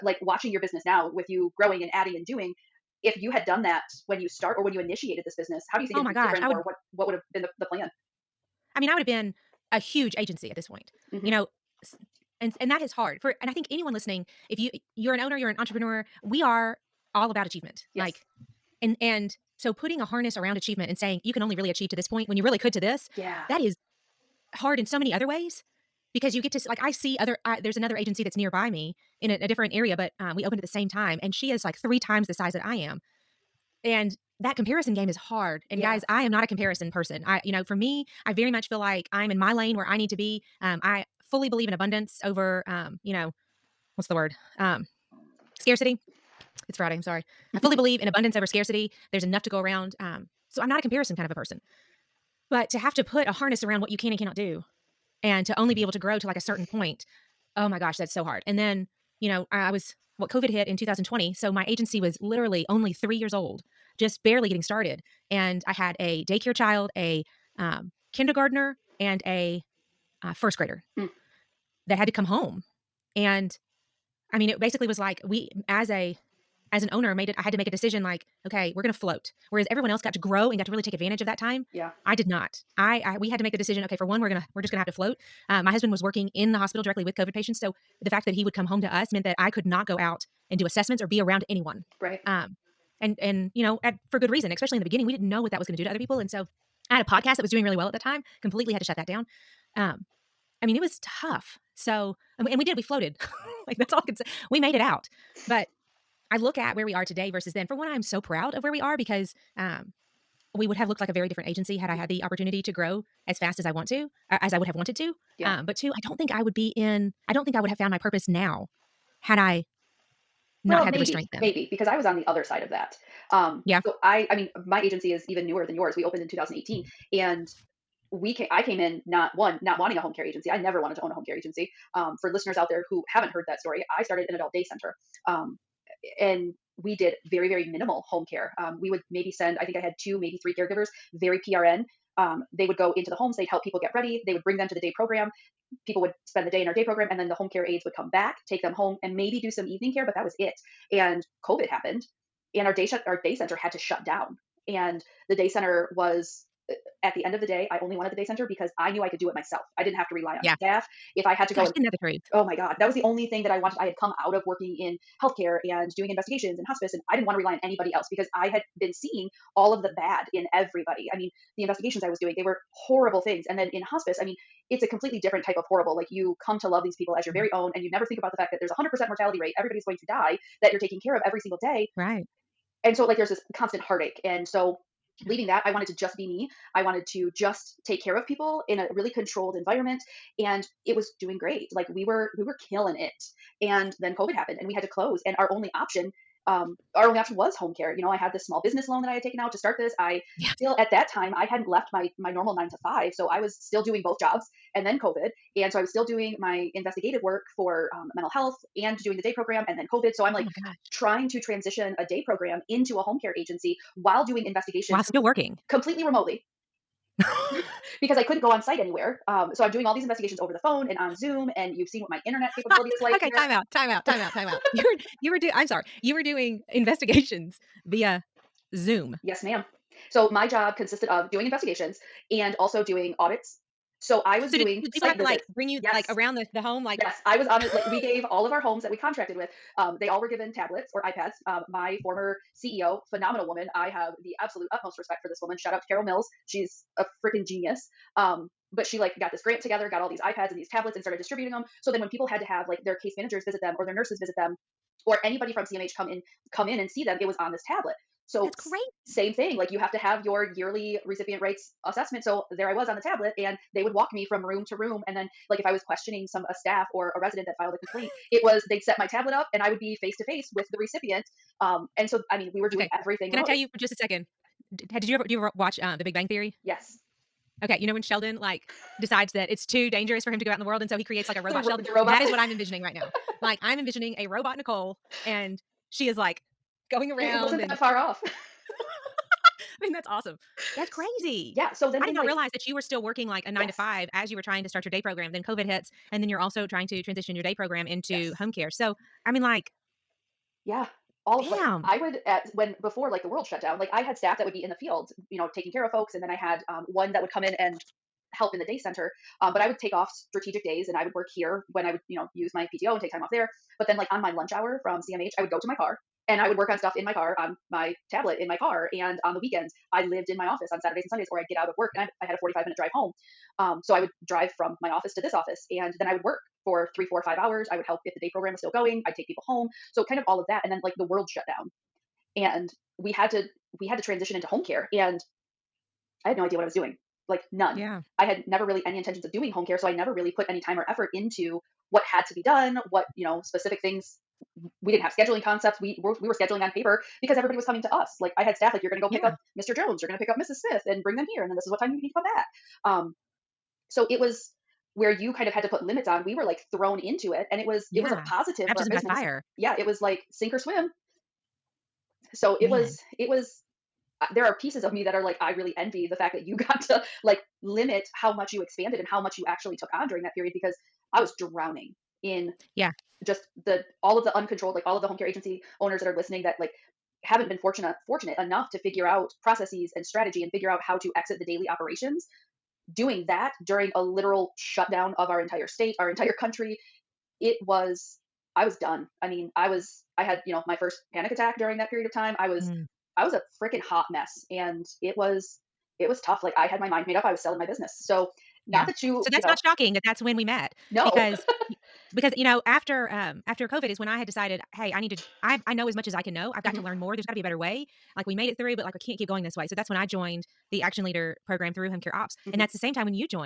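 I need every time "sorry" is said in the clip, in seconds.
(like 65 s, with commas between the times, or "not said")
47 s, 225 s.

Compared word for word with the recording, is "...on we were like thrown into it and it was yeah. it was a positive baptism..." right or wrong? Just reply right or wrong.
right.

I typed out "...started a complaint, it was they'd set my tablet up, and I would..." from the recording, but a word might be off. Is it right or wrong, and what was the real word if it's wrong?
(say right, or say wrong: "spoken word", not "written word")
wrong: "filed", not "started".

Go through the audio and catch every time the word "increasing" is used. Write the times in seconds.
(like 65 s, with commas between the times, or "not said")
not said.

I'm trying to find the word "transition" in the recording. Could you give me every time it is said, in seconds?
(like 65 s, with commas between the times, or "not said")
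211 s, 297 s, 334 s.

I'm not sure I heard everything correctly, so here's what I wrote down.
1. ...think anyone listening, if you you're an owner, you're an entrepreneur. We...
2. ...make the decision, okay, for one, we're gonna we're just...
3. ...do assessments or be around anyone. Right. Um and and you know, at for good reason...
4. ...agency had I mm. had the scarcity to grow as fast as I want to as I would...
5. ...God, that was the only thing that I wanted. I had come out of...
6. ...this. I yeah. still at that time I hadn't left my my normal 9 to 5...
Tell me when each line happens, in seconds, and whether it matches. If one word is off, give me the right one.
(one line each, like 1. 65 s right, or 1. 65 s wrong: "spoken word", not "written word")
1. 13 s right
2. 83 s right
3. 90 s right
4. 111 s wrong: "opportunity", not "scarcity"
5. 162 s right
6. 199 s right.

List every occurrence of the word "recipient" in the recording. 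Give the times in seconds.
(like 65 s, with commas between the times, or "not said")
261 s, 270 s.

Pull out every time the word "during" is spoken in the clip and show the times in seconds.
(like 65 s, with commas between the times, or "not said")
370 s, 383 s, 391 s.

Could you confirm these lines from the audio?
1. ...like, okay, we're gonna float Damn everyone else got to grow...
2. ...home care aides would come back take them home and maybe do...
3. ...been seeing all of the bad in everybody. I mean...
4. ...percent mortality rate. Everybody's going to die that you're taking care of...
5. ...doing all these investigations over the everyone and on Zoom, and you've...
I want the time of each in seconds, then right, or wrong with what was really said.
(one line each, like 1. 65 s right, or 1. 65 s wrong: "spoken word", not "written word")
1. 78 s wrong: "Whereas", not "Damn"
2. 147 s right
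3. 168 s right
4. 178 s right
5. 219 s wrong: "phone", not "everyone".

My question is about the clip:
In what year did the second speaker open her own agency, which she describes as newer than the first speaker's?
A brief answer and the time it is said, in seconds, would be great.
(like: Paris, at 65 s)
2018, at 126 s.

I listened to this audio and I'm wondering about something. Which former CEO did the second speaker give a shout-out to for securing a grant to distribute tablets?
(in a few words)
Carol Mills.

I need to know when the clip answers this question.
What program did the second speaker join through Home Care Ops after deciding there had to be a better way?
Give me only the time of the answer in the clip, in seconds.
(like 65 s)
410 s.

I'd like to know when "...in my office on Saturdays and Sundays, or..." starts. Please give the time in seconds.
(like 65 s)
320 s.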